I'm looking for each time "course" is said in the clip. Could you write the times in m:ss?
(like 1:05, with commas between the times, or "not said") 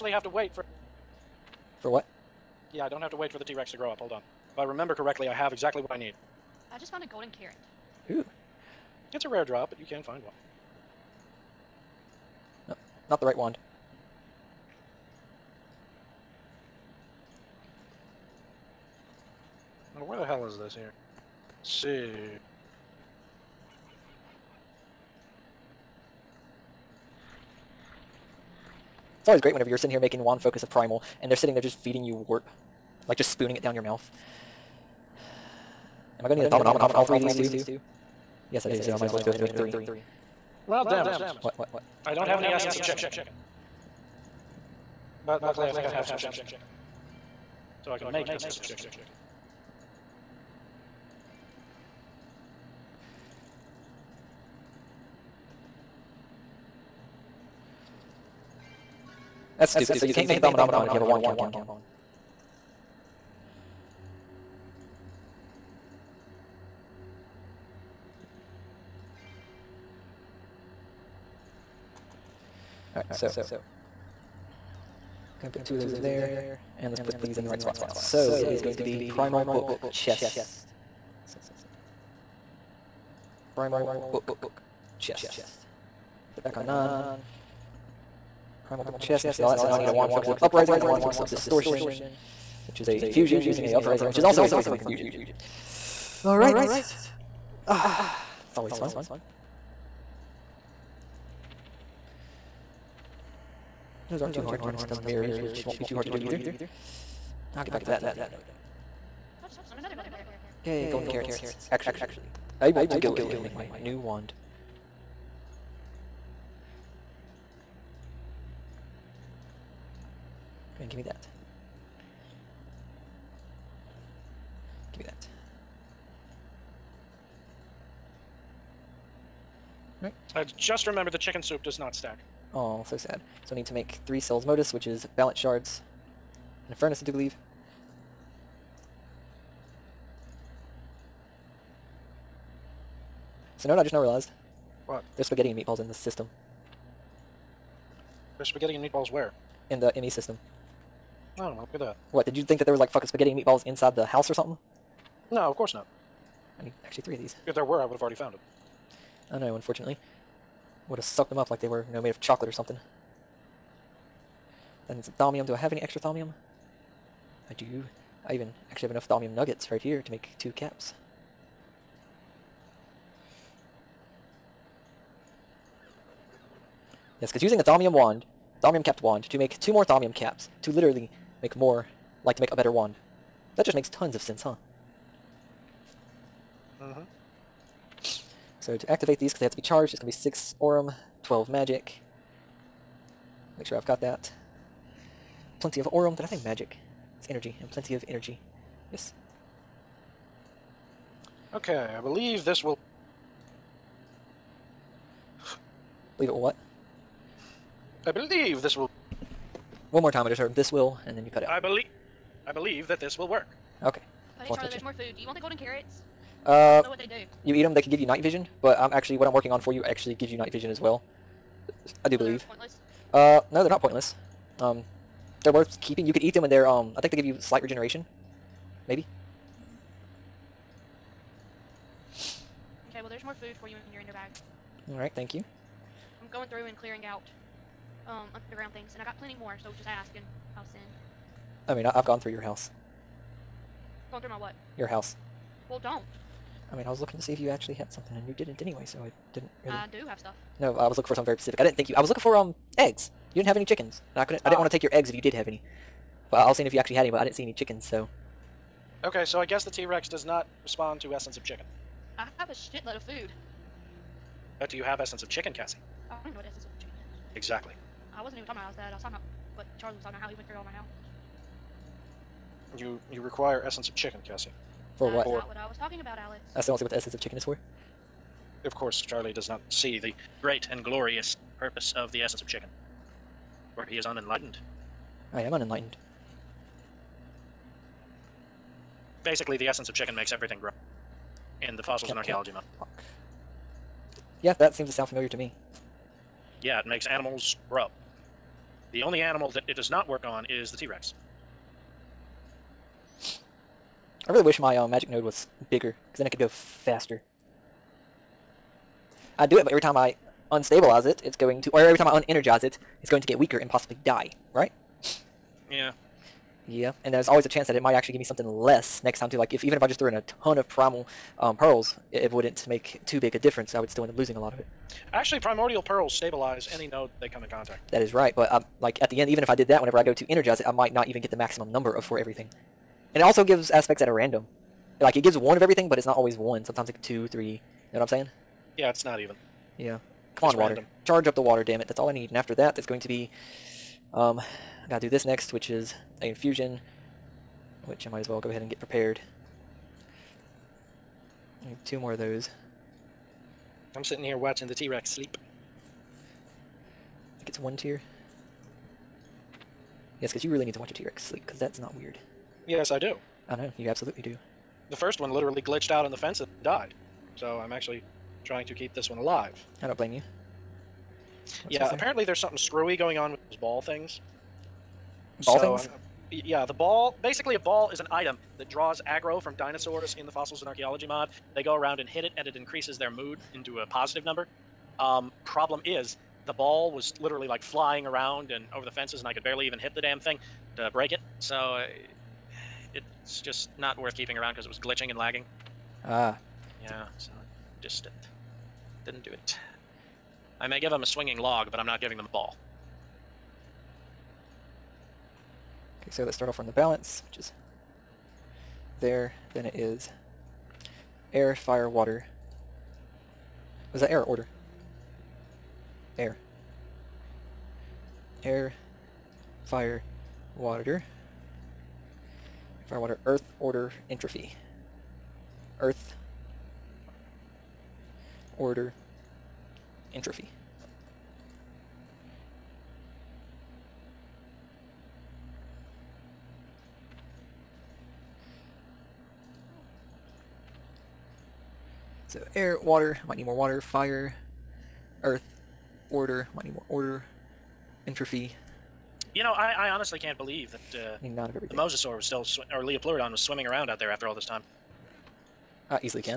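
2:35, 4:38.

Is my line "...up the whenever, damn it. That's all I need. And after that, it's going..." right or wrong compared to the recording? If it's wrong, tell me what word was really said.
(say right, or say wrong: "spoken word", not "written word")
wrong: "water", not "whenever".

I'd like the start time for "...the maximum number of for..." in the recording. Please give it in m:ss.
5:31.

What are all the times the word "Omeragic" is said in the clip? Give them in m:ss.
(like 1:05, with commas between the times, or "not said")
not said.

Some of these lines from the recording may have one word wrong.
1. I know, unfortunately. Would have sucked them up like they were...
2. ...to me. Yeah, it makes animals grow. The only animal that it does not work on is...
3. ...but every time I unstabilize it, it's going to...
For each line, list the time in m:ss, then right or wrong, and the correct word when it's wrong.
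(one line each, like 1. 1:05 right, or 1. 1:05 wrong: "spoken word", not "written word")
1. 2:39 right
2. 4:55 right
3. 5:09 right.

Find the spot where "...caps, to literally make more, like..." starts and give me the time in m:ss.
3:00.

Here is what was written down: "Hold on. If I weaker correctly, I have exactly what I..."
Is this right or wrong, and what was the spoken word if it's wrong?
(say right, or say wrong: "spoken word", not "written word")
wrong: "remember", not "weaker".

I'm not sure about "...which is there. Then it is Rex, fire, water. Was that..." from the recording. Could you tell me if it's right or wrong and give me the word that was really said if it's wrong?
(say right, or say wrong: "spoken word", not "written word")
wrong: "Air", not "Rex".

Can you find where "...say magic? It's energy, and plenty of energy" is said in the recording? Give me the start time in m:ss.
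3:16.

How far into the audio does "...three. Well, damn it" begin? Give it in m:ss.
0:39.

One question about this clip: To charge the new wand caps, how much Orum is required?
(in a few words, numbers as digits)
6.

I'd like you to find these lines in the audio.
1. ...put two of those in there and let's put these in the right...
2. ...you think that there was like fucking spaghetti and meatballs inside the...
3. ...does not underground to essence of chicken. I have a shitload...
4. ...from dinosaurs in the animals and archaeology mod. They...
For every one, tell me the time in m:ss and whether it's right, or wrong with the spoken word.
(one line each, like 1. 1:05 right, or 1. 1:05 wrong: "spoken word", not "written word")
1. 1:15 right
2. 2:32 right
3. 4:20 wrong: "respond", not "underground"
4. 6:19 wrong: "fossils", not "animals".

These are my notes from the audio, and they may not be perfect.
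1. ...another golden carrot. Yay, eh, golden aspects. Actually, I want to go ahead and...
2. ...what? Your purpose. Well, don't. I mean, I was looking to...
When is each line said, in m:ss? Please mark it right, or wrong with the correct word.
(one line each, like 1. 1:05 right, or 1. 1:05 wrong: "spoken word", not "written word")
1. 1:49 wrong: "carrots", not "aspects"
2. 4:04 wrong: "house", not "purpose".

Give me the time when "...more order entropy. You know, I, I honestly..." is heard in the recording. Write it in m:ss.
7:26.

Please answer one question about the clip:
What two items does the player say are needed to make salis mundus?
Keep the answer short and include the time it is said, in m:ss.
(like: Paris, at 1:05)
Balance shards and a furnace, at 2:15.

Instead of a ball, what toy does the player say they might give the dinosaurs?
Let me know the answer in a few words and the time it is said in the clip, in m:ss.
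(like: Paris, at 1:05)
A swinging log, at 6:41.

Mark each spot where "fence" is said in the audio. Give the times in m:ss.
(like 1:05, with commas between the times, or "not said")
6:06, 6:28.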